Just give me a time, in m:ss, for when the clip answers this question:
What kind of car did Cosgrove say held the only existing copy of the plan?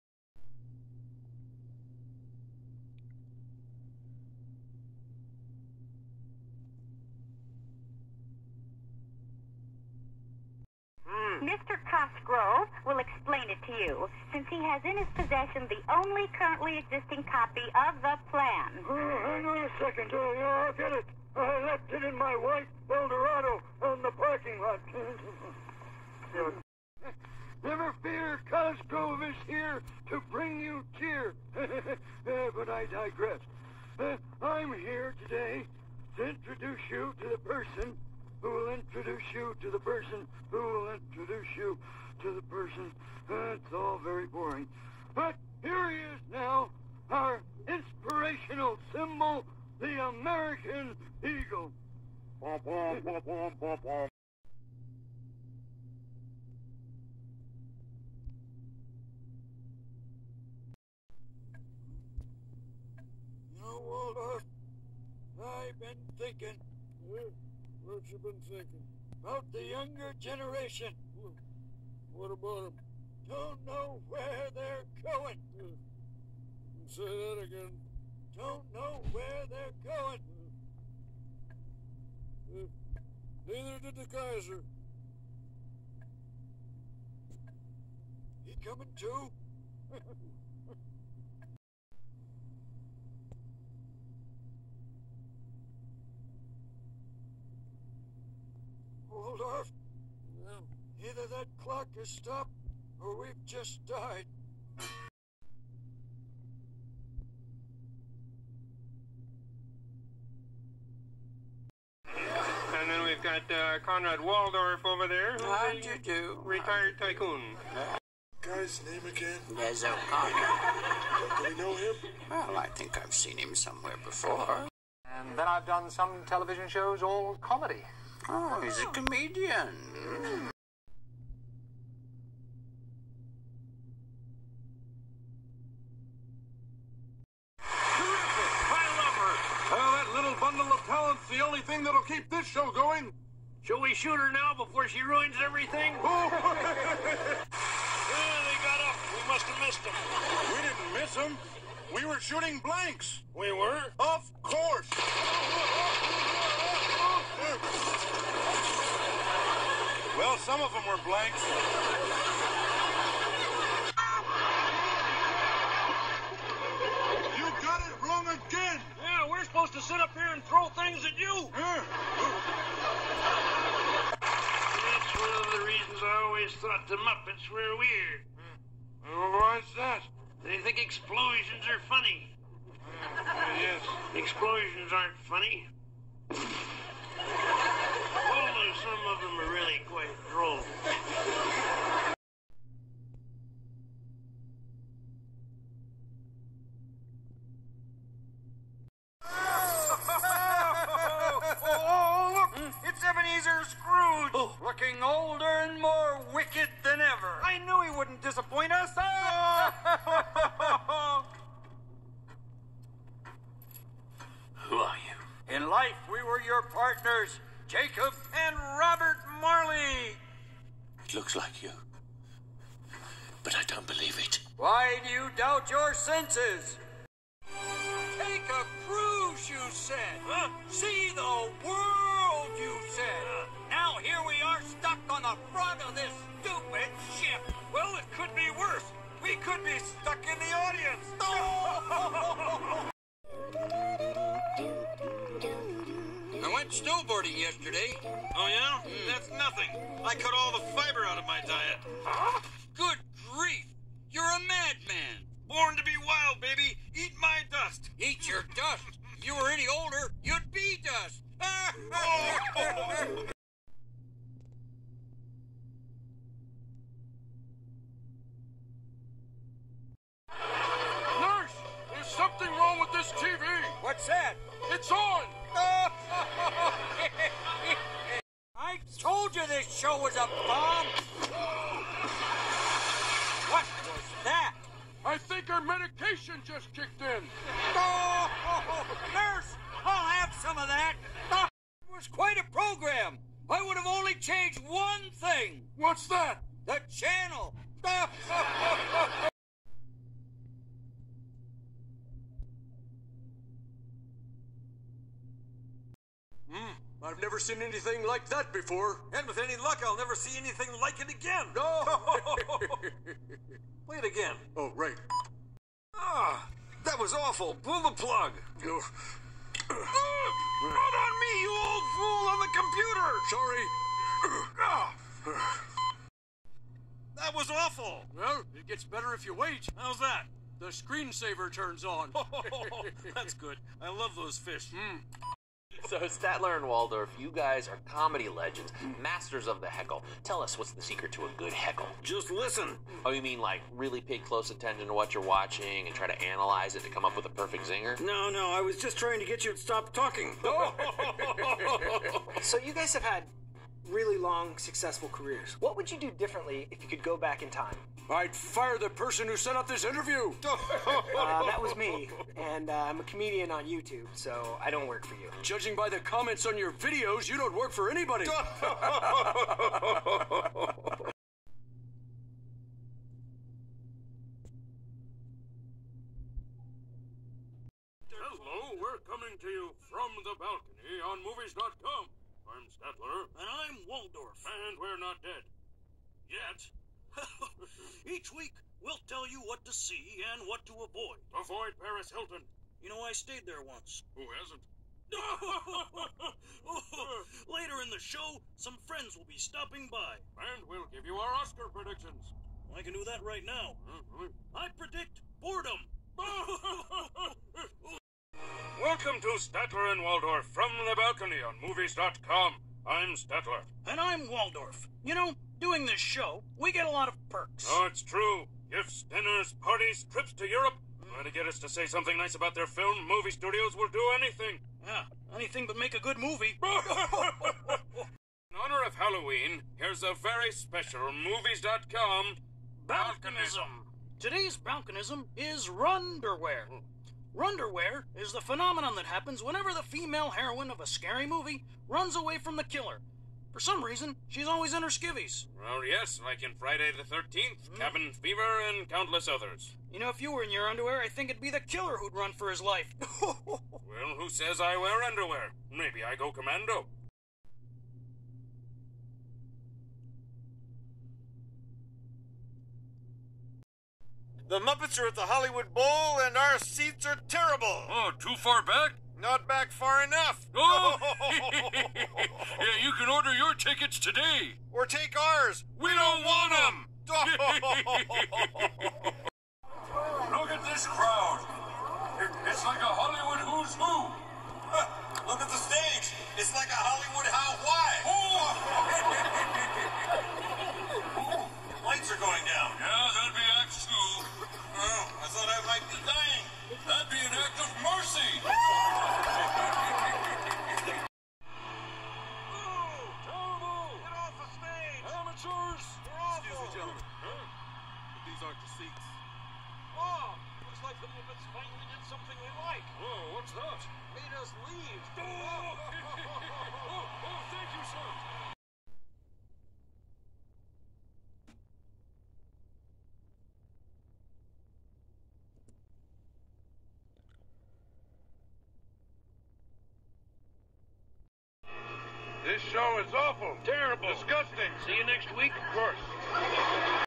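0:22.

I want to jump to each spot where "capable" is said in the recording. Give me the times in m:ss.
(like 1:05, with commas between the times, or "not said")
not said.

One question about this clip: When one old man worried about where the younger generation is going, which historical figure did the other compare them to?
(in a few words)
The Kaiser.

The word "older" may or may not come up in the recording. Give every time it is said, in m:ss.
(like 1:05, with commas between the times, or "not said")
3:25, 4:19.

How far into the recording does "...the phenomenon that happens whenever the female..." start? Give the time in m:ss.
7:18.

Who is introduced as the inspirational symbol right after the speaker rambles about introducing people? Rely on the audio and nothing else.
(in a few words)
The American Eagle.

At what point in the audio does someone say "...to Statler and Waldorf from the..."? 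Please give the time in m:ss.
6:49.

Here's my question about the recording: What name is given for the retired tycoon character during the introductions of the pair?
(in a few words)
Conrad Waldorf.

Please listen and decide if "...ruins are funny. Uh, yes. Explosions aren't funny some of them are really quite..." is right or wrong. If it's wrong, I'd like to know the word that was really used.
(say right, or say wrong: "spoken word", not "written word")
wrong: "explosions", not "ruins".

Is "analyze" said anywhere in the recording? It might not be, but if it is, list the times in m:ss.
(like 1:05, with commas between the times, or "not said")
5:46.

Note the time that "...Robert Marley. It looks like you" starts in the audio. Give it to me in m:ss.
3:38.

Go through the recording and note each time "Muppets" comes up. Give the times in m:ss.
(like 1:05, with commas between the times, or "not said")
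2:56, 7:44, 8:31.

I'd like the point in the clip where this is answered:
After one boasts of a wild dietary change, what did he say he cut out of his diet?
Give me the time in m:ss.
4:10.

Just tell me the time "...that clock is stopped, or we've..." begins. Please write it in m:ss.
1:41.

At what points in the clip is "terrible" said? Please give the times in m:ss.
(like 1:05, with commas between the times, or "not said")
7:47, 8:53.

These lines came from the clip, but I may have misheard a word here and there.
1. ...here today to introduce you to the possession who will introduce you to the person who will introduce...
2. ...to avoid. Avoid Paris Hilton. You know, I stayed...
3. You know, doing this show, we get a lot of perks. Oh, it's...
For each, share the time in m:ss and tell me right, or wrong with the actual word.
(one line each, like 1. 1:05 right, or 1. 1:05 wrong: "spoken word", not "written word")
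1. 0:34 wrong: "person", not "possession"
2. 6:30 right
3. 6:55 right.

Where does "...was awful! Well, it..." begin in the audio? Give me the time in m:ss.
5:27.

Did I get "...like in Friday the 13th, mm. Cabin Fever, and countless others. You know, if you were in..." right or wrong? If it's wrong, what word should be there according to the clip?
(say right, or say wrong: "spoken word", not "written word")
right.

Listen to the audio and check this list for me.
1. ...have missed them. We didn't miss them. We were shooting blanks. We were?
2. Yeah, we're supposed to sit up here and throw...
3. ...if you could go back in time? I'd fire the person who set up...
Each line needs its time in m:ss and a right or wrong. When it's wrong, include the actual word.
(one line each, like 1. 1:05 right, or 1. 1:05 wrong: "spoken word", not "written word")
1. 2:29 right
2. 2:49 right
3. 5:56 right.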